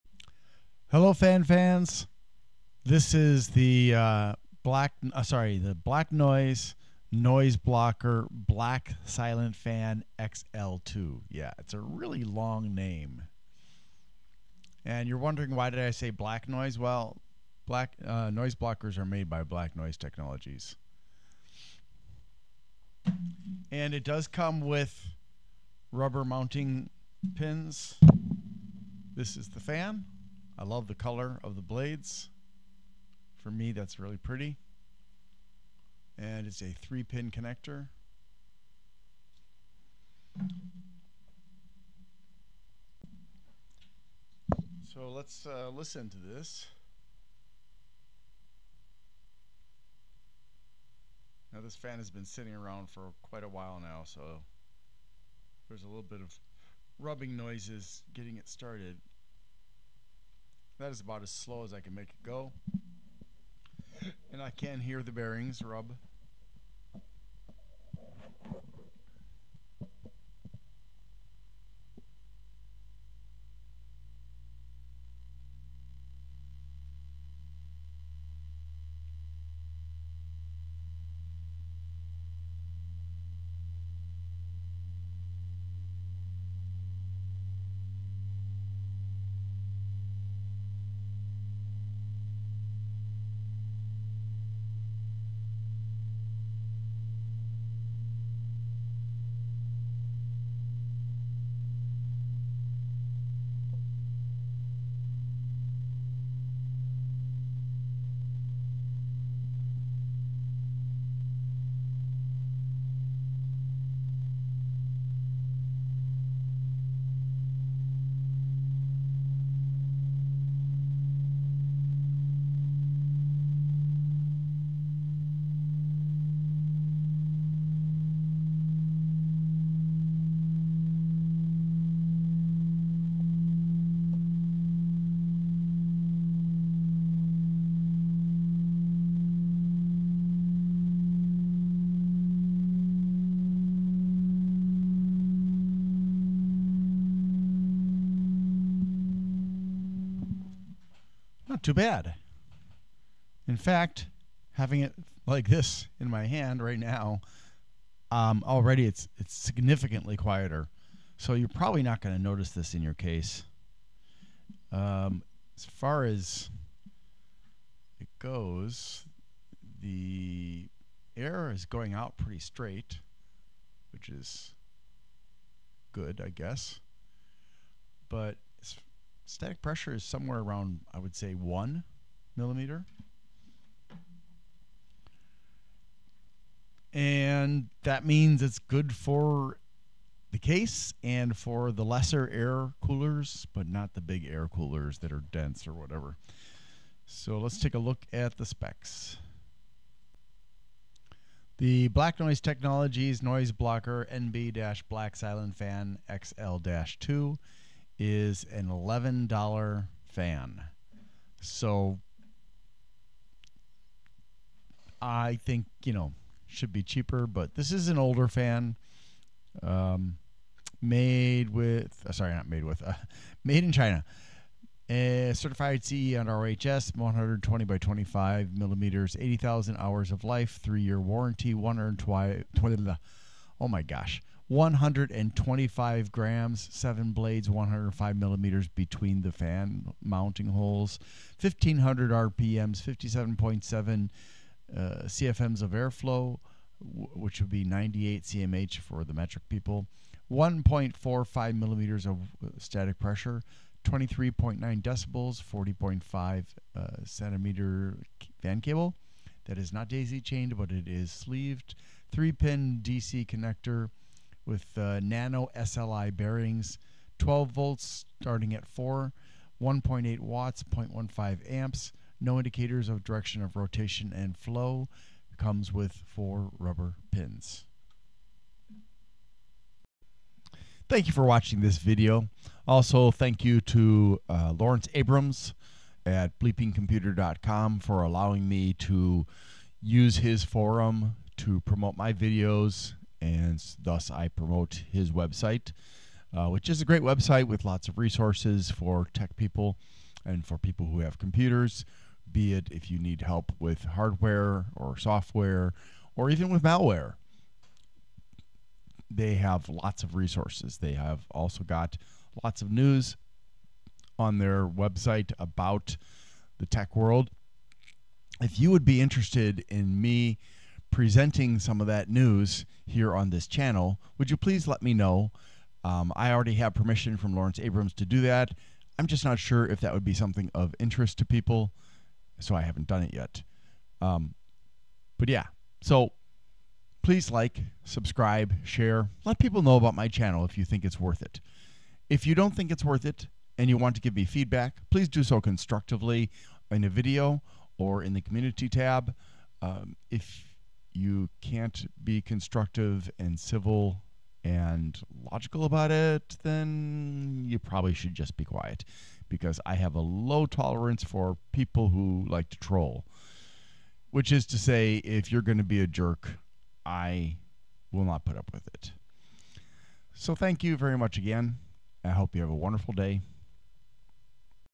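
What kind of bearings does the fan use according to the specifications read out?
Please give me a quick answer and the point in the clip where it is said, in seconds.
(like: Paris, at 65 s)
nano SLI bearings, at 265 s.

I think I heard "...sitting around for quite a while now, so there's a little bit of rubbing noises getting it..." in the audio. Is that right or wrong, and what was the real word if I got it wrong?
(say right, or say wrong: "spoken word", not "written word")
right.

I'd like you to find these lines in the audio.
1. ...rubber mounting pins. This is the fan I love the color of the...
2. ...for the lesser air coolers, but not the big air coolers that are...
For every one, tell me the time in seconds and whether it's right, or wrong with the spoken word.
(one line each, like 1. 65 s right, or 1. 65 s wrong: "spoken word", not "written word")
1. 25 s right
2. 191 s right.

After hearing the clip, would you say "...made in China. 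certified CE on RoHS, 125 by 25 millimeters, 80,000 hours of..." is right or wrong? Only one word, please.
wrong.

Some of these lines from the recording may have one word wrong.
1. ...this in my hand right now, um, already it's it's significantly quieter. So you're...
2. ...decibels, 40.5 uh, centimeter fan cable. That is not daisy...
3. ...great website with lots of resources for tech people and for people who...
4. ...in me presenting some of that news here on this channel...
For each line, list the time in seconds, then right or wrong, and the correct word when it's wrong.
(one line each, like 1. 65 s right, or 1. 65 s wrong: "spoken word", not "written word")
1. 155 s right
2. 254 s right
3. 296 s right
4. 319 s right.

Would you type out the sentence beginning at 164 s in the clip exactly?
Um, as far as it goes, the air is going out pretty straight, which is good, I guess.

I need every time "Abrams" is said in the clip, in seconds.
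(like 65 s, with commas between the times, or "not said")
284 s, 327 s.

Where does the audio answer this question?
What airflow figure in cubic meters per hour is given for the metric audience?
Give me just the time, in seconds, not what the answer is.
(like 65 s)
247 s.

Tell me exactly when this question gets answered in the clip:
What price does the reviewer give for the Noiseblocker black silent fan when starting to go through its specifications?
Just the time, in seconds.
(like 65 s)
208 s.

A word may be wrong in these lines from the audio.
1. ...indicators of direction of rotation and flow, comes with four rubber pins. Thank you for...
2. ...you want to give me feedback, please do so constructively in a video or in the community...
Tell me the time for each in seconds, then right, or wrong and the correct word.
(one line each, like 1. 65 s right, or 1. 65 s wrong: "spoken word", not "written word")
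1. 272 s right
2. 343 s right.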